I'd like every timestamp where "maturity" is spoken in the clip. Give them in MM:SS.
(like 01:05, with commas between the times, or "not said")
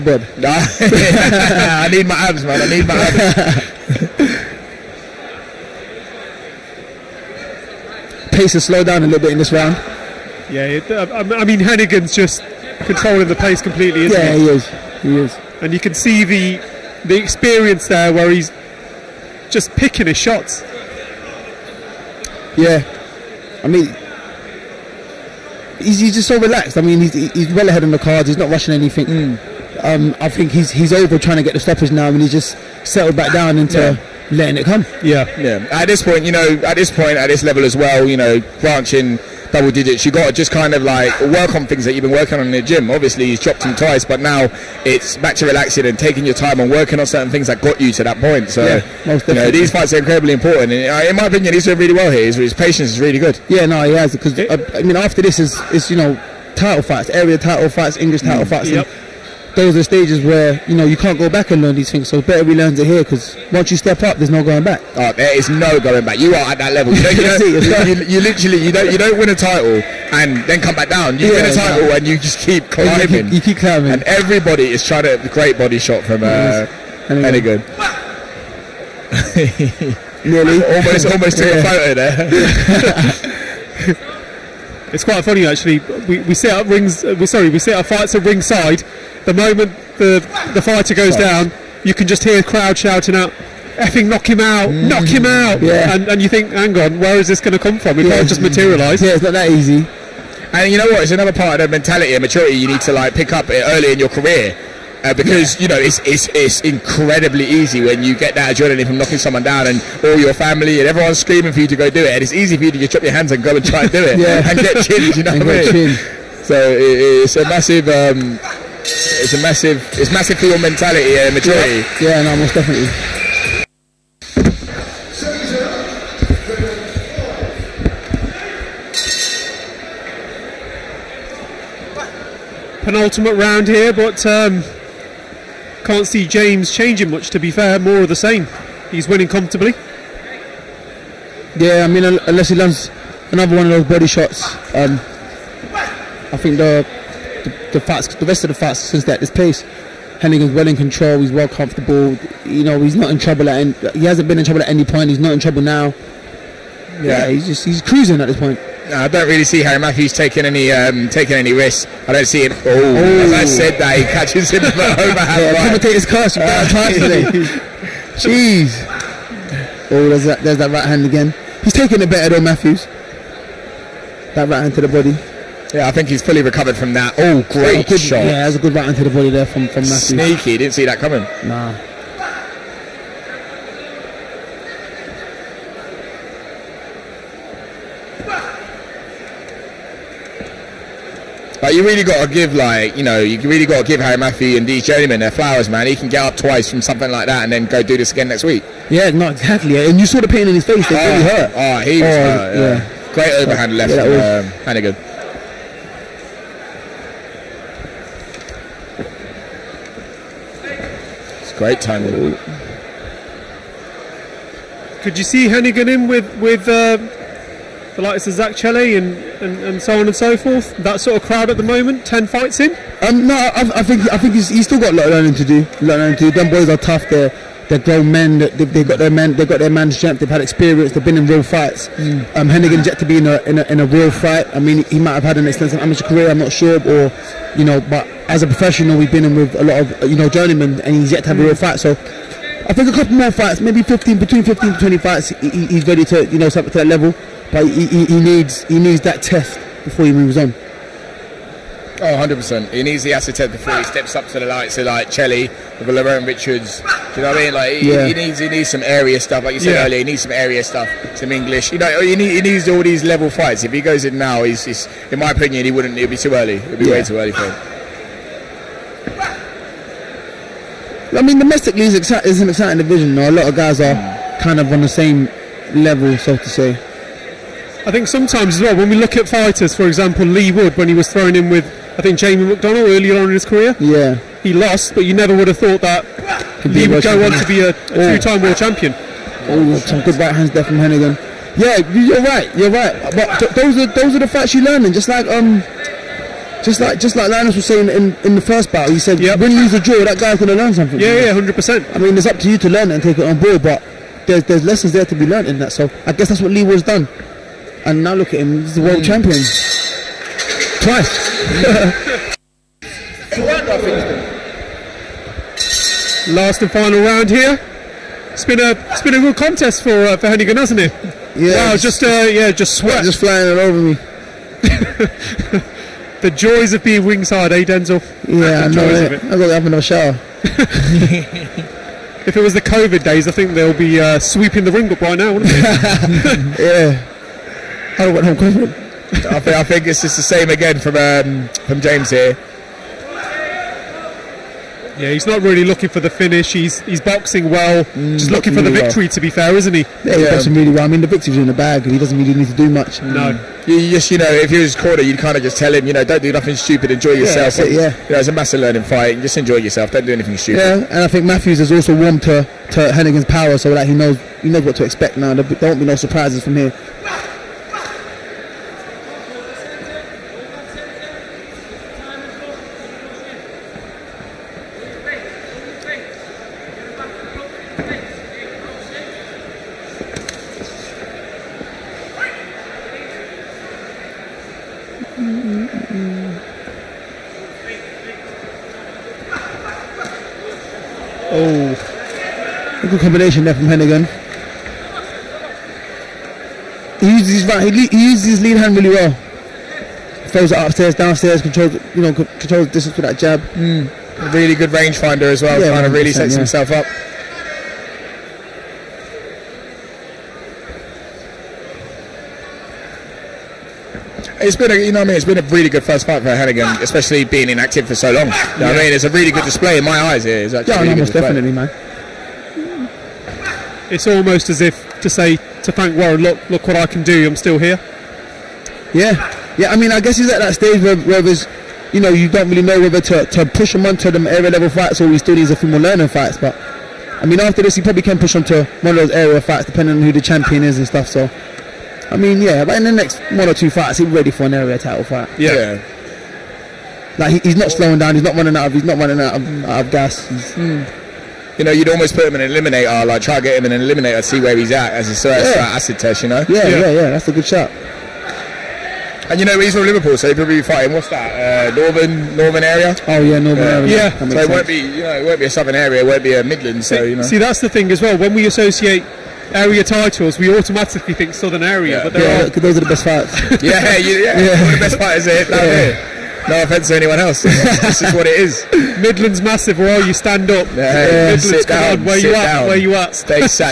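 01:42, 02:01.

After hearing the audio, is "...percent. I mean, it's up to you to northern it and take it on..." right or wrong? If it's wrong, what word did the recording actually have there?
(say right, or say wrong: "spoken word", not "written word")
wrong: "learn", not "northern".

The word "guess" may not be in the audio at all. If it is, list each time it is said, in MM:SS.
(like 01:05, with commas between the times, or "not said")
05:06, 07:09.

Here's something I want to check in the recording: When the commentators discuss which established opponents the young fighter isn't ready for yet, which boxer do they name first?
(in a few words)
Zak Chelli.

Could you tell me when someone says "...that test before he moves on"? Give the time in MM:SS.
04:09.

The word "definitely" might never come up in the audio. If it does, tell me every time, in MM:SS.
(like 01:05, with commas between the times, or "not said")
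02:02, 07:01.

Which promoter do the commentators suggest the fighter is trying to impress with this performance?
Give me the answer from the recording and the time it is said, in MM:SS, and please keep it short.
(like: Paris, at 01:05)
Warren, at 07:05.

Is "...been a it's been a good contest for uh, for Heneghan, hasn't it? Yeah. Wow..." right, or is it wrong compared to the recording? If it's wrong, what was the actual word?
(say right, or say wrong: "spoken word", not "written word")
right.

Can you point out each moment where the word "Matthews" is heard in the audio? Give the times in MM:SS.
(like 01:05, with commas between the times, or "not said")
02:39, 02:52, 02:59, 03:14, 06:01.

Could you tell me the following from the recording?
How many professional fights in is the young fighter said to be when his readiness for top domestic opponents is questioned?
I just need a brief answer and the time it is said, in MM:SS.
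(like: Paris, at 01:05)
10, at 03:42.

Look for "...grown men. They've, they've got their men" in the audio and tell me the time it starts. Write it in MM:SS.
03:47.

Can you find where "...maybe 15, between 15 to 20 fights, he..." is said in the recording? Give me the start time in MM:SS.
04:03.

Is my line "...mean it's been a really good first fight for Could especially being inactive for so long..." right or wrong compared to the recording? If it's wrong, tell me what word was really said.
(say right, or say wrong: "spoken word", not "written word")
wrong: "Heneghan", not "Could".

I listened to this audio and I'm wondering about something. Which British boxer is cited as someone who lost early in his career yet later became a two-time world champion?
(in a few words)
Leigh Wood.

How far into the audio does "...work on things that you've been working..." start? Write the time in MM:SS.
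00:41.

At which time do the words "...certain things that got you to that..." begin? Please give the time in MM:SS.
00:47.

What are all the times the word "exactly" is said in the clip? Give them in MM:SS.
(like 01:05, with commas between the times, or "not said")
01:11, 03:19.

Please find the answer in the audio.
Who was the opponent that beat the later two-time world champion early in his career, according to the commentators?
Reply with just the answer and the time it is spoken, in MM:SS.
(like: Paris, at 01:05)
Jamie McDonald, at 04:42.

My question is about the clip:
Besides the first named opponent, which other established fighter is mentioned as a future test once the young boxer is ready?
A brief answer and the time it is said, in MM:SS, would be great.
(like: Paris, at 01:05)
Laverne Richards, at 04:15.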